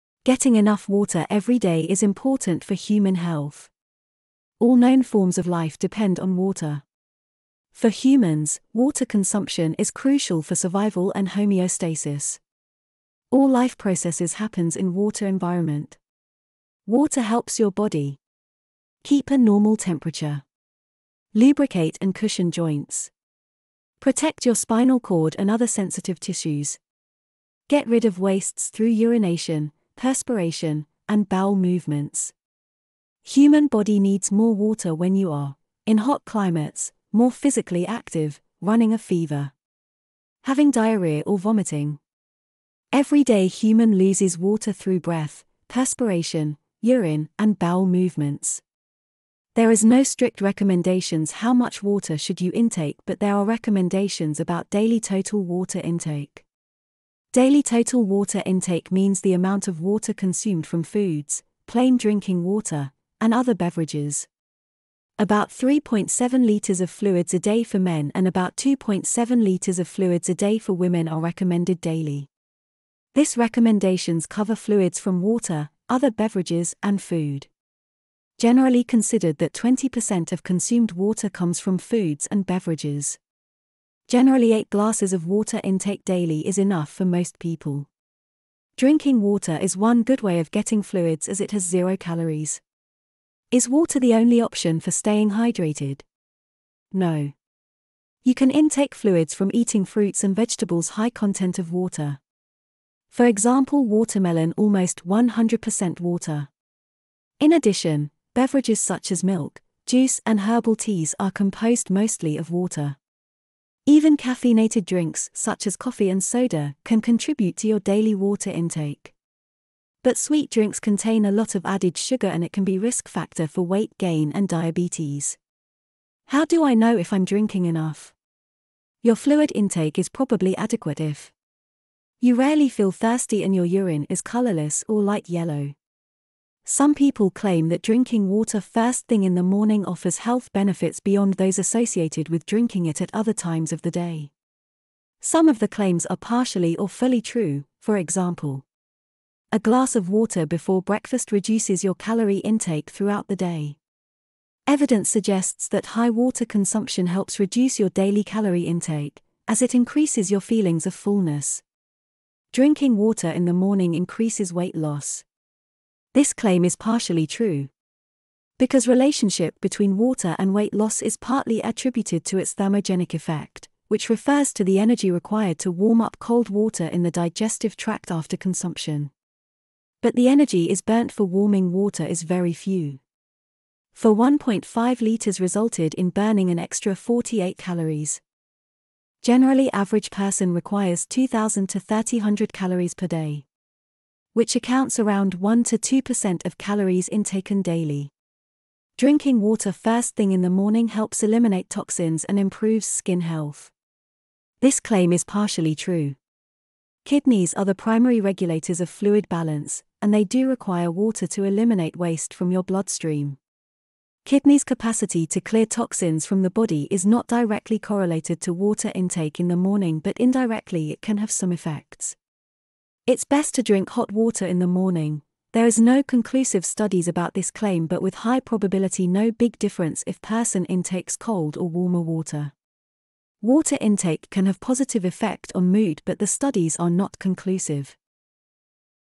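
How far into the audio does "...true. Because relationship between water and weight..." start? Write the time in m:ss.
2:47.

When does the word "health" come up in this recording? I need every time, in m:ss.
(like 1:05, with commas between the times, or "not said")
0:03, 2:20, 3:23.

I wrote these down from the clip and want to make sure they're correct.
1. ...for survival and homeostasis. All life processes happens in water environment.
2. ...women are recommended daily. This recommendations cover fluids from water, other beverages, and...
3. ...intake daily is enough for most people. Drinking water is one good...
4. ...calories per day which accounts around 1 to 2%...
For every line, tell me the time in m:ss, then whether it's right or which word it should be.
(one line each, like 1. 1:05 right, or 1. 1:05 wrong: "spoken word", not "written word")
1. 0:10 right
2. 1:10 right
3. 1:25 right
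4. 3:12 right.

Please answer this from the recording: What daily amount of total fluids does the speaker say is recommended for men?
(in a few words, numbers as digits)
3.7 litres.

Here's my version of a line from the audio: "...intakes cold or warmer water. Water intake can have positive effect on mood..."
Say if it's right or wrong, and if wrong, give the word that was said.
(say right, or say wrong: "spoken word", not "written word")
right.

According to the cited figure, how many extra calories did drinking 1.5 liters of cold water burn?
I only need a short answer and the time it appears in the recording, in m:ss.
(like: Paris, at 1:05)
48, at 3:06.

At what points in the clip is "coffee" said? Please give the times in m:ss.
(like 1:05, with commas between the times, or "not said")
1:55.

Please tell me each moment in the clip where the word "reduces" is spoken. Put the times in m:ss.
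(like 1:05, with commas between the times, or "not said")
2:31, 2:37.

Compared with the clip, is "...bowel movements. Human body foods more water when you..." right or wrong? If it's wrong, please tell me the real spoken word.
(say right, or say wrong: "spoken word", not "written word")
wrong: "needs", not "foods".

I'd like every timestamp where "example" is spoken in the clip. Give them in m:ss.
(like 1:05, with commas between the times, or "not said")
1:43, 2:27.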